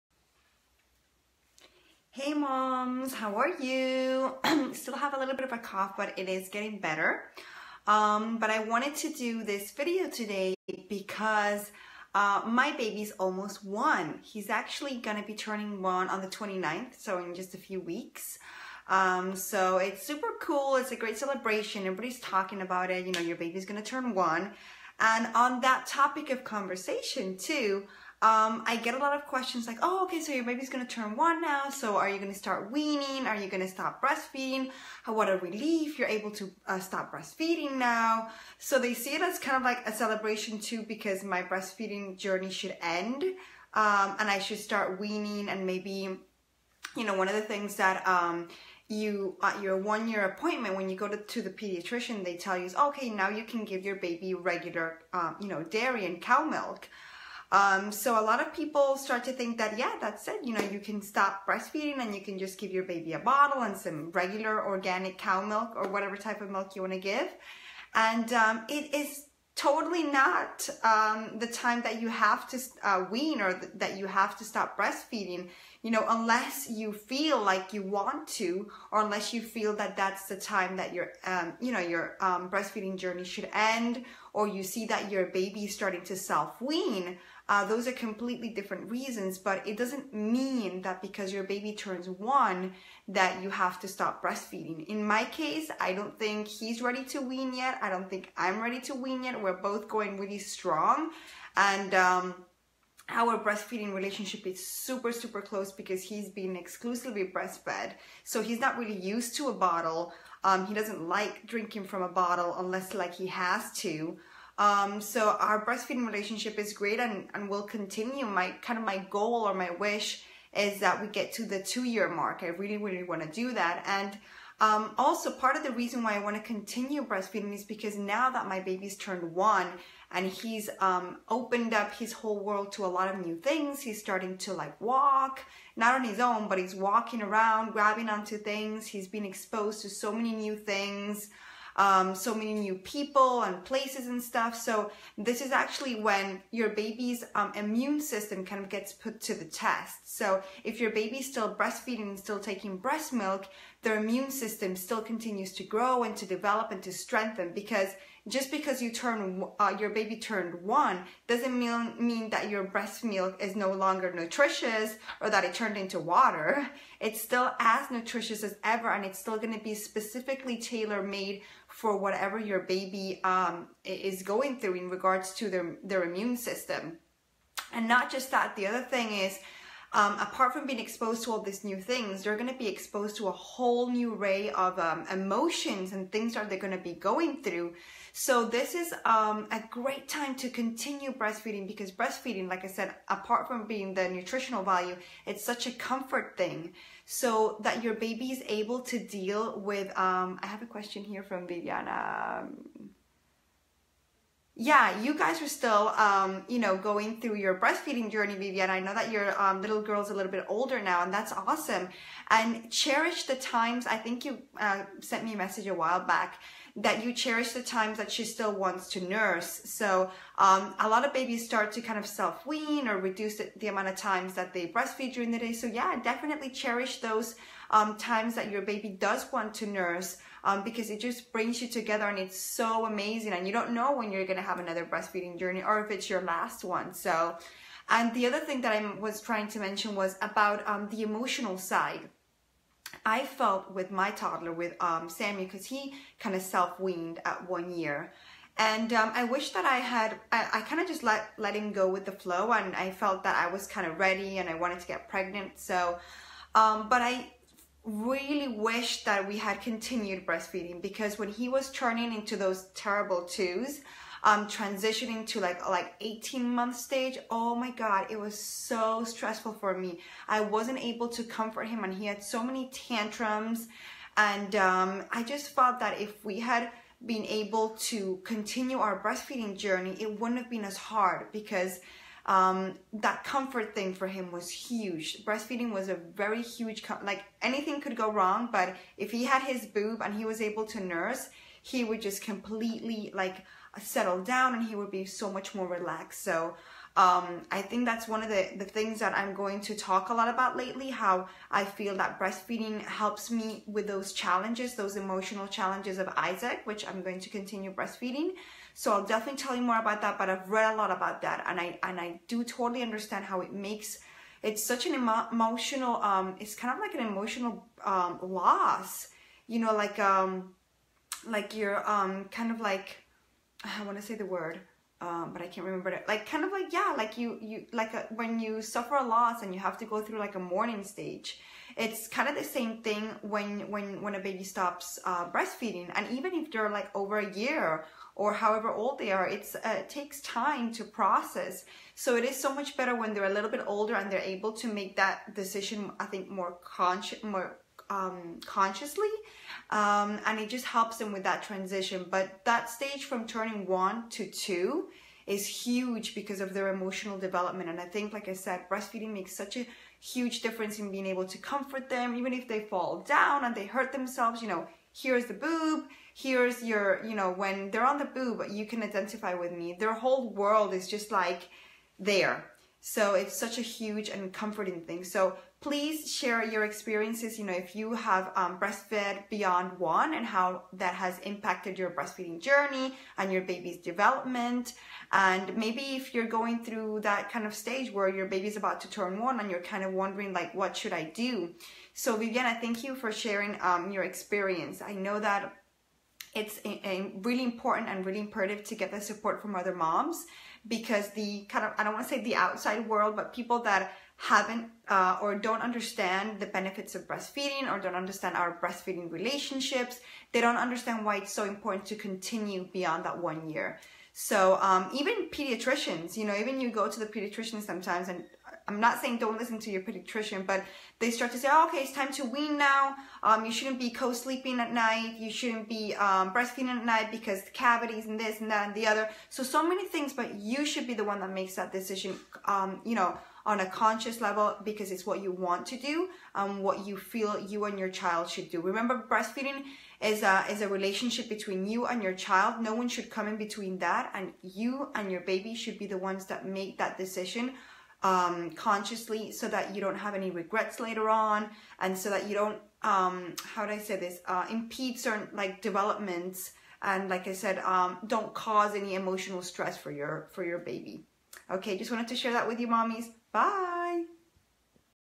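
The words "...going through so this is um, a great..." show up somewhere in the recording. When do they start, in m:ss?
3:06.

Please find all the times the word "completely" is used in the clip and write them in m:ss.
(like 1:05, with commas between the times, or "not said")
1:27, 4:52.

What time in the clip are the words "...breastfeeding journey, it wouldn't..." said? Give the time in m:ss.
4:39.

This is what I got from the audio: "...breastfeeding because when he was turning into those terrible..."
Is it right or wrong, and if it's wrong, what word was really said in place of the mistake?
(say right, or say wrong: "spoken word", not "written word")
right.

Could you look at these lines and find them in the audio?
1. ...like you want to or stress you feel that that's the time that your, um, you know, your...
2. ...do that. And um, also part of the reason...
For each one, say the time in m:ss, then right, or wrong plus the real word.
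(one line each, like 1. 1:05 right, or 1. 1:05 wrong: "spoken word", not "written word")
1. 1:17 wrong: "unless", not "stress"
2. 2:03 right.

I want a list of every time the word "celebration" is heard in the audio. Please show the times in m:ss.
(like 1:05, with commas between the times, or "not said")
0:21, 0:39.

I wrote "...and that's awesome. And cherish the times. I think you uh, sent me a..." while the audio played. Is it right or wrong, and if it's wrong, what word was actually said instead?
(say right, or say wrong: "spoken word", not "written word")
right.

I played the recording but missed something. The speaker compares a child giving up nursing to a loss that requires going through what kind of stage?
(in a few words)
Mourning stage.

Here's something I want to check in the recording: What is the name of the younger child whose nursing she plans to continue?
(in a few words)
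Isaac.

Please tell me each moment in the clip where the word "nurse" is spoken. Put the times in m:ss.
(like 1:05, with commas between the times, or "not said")
3:39, 3:49, 4:50.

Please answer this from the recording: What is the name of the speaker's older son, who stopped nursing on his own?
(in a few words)
Sammy.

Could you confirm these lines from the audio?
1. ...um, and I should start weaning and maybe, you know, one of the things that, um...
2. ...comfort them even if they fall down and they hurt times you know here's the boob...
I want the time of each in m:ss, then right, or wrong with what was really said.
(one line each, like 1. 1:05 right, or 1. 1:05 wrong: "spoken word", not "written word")
1. 0:43 right
2. 6:01 wrong: "themselves", not "times".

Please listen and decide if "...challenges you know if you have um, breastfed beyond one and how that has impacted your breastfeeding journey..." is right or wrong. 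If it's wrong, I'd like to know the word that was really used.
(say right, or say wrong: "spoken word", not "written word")
wrong: "experiences", not "challenges".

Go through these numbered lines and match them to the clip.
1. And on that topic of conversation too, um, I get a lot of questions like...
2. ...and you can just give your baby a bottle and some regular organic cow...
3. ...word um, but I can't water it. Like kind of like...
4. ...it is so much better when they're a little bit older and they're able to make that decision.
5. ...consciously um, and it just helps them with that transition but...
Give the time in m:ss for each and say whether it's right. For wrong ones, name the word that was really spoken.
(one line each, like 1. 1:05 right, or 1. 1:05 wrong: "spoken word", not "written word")
1. 0:24 right
2. 1:01 right
3. 5:24 wrong: "remember", not "water"
4. 5:42 right
5. 5:48 right.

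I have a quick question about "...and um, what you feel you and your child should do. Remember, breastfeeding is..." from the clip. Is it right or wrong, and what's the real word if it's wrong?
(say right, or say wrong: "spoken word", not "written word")
right.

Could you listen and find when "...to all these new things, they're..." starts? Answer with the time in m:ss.
3:01.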